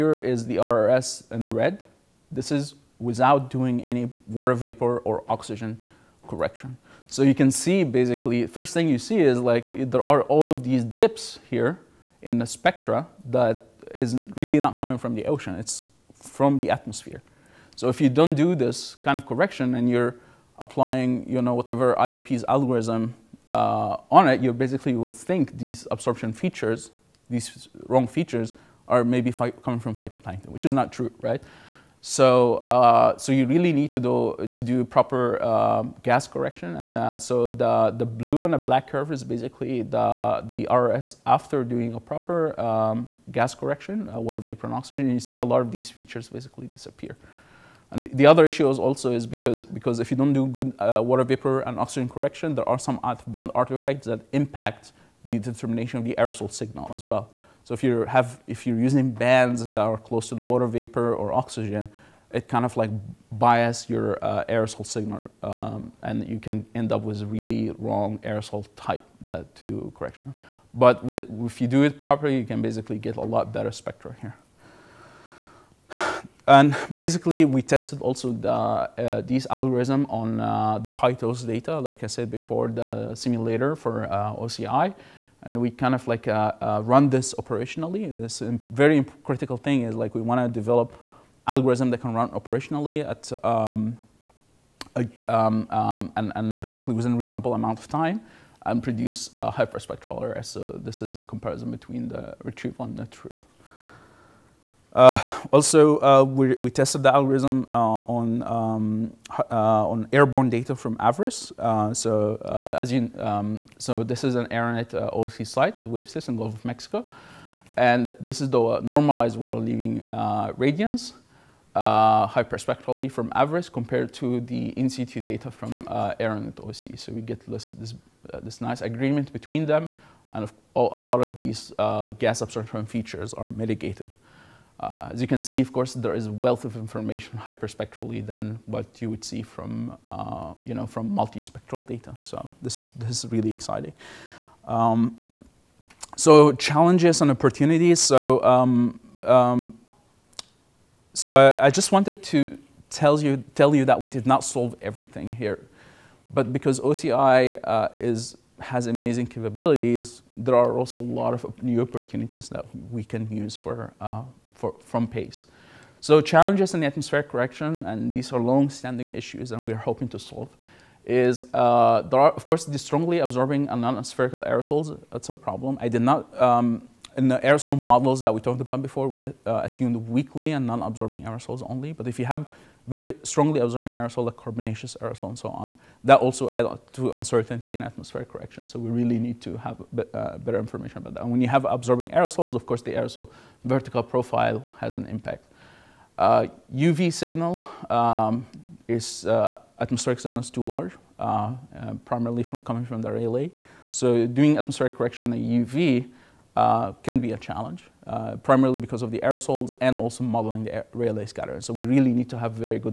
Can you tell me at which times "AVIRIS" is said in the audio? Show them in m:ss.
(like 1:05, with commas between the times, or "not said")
1:50, 2:03.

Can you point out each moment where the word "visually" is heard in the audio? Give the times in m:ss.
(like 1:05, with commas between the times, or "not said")
not said.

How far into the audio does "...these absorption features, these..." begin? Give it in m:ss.
0:25.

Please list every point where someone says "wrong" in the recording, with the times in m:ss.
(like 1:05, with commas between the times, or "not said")
0:27, 1:07.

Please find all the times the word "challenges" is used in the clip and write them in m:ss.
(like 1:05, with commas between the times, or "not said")
2:26, 2:46, 3:27.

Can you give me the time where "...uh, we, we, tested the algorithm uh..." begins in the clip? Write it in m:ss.
1:46.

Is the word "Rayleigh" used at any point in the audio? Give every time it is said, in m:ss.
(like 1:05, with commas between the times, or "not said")
3:23, 3:30.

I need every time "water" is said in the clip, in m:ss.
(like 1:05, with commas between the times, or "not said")
0:04, 0:44, 0:51, 1:00, 1:59.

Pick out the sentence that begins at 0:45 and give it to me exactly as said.
you see a lot of these features basically disappear.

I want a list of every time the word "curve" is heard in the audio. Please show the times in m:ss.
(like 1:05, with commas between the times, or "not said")
0:38.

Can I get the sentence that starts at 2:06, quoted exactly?
So we get this, this, uh, this, nice agreement between them, and a lot of these uh, gas absorption features are mitigated.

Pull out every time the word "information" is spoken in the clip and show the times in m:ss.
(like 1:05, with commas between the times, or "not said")
2:16, 3:10.